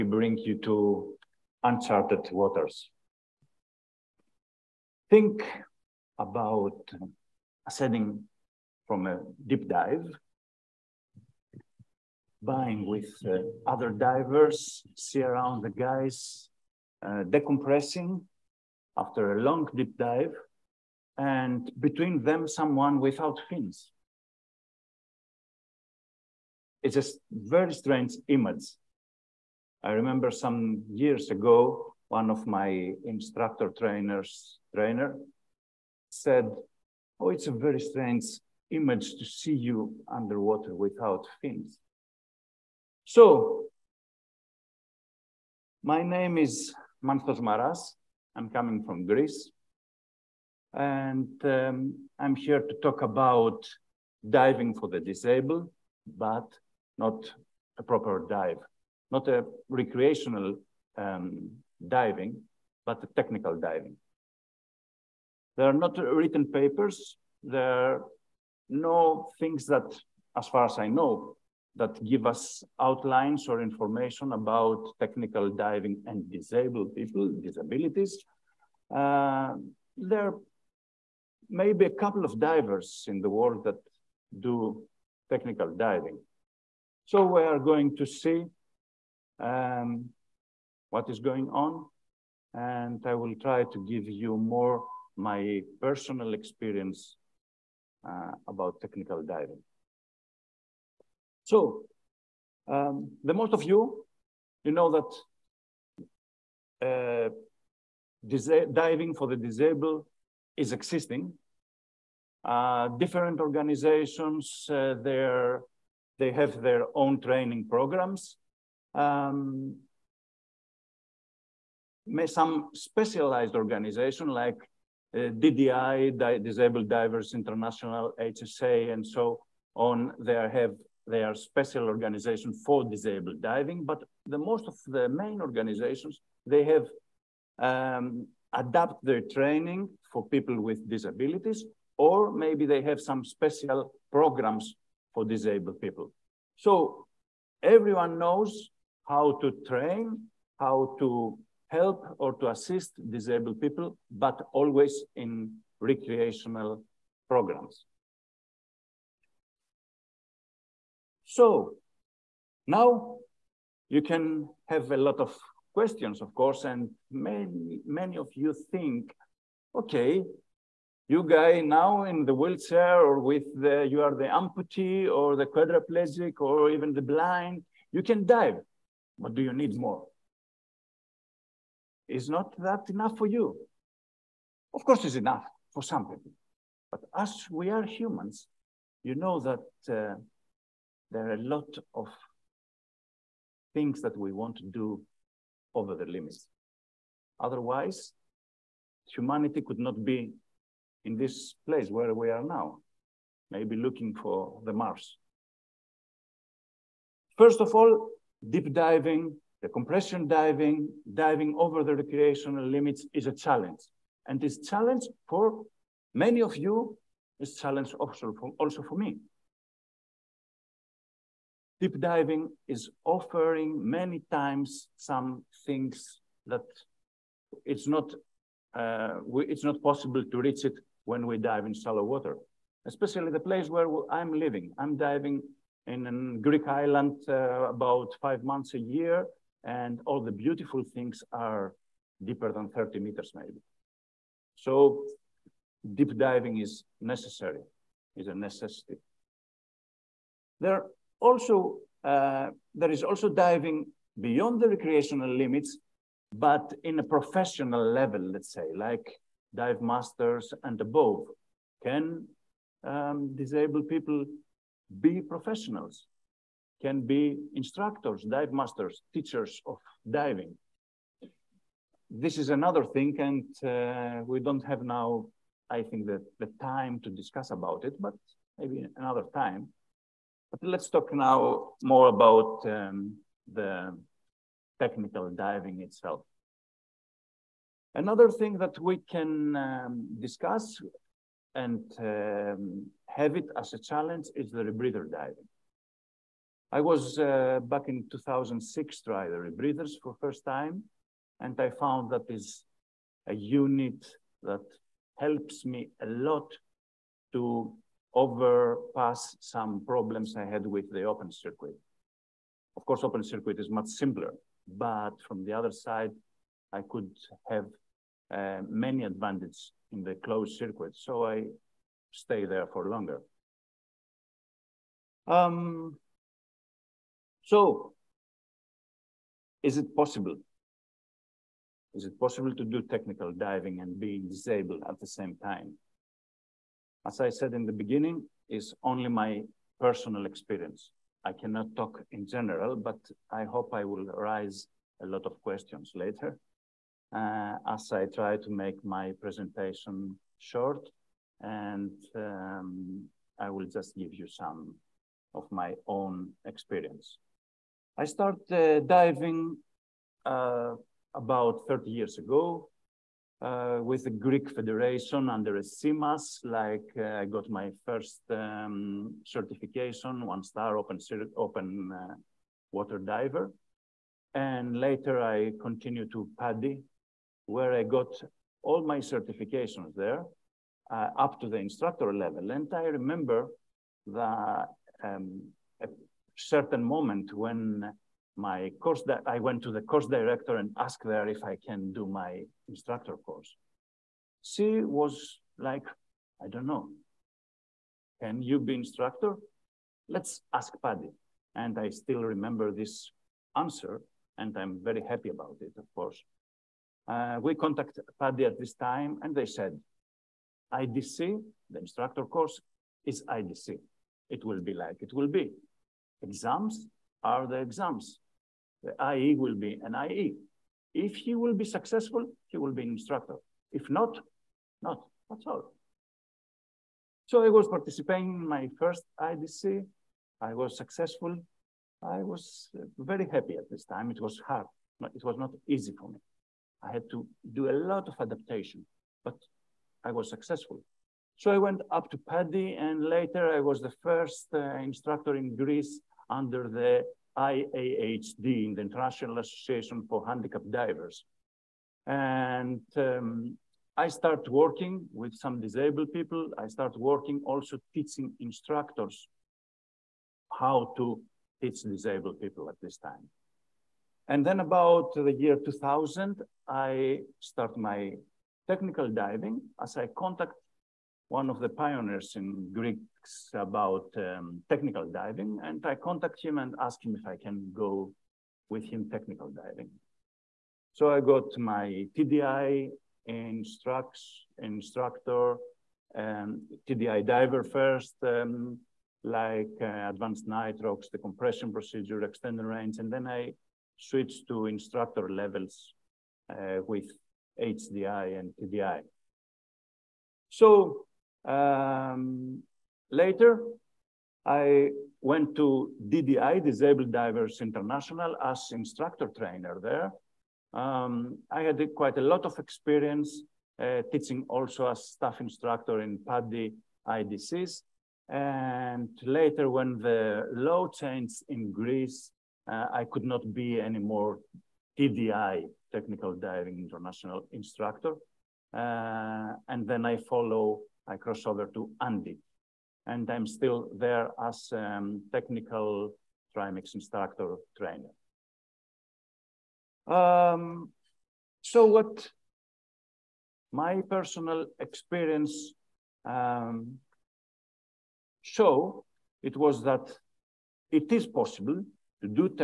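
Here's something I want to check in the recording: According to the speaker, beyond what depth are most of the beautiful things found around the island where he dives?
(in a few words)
30 meters.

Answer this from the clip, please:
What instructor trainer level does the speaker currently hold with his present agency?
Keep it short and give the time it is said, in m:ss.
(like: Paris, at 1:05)
Technical Trimix instructor trainer, at 8:55.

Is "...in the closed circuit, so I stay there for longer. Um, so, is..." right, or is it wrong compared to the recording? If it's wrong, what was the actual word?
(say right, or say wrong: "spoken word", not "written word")
right.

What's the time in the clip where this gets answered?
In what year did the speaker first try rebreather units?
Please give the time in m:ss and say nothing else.
4:58.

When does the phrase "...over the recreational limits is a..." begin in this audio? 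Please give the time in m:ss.
3:31.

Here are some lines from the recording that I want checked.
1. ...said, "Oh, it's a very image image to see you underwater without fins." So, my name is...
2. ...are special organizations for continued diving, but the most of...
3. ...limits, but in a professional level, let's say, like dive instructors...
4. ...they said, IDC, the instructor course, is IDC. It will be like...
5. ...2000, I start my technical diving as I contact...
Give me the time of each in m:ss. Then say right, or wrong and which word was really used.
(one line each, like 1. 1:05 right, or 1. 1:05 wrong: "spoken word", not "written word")
1. 0:36 wrong: "strange", not "image"
2. 2:11 wrong: "disabled", not "continued"
3. 4:15 wrong: "masters", not "instructors"
4. 6:49 right
5. 7:45 right.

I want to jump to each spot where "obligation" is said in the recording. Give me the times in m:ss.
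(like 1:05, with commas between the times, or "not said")
not said.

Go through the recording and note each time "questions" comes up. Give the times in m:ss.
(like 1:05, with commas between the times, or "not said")
2:45, 5:45.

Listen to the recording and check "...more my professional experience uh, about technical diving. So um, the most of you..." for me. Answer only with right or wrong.
wrong.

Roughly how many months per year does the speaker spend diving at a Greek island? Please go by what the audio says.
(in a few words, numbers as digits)
5.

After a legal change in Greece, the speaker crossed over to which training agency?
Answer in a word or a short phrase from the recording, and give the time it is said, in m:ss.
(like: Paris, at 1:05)
ANDI, at 8:52.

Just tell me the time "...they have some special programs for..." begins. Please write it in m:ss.
2:22.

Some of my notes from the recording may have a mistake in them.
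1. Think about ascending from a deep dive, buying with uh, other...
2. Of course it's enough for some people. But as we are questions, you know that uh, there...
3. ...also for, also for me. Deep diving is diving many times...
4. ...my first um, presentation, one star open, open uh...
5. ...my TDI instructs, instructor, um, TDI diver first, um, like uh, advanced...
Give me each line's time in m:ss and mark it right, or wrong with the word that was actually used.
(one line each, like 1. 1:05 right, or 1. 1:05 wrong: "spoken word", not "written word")
1. 0:05 right
2. 3:04 wrong: "humans", not "questions"
3. 3:37 wrong: "offering", not "diving"
4. 6:07 wrong: "certification", not "presentation"
5. 8:01 right.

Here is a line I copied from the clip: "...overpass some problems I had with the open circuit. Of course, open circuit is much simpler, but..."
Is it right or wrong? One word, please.
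right.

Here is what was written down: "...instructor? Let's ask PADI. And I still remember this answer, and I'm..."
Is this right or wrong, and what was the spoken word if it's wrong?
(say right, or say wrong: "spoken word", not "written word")
right.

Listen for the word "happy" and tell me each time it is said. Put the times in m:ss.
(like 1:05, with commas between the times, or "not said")
6:45, 7:13.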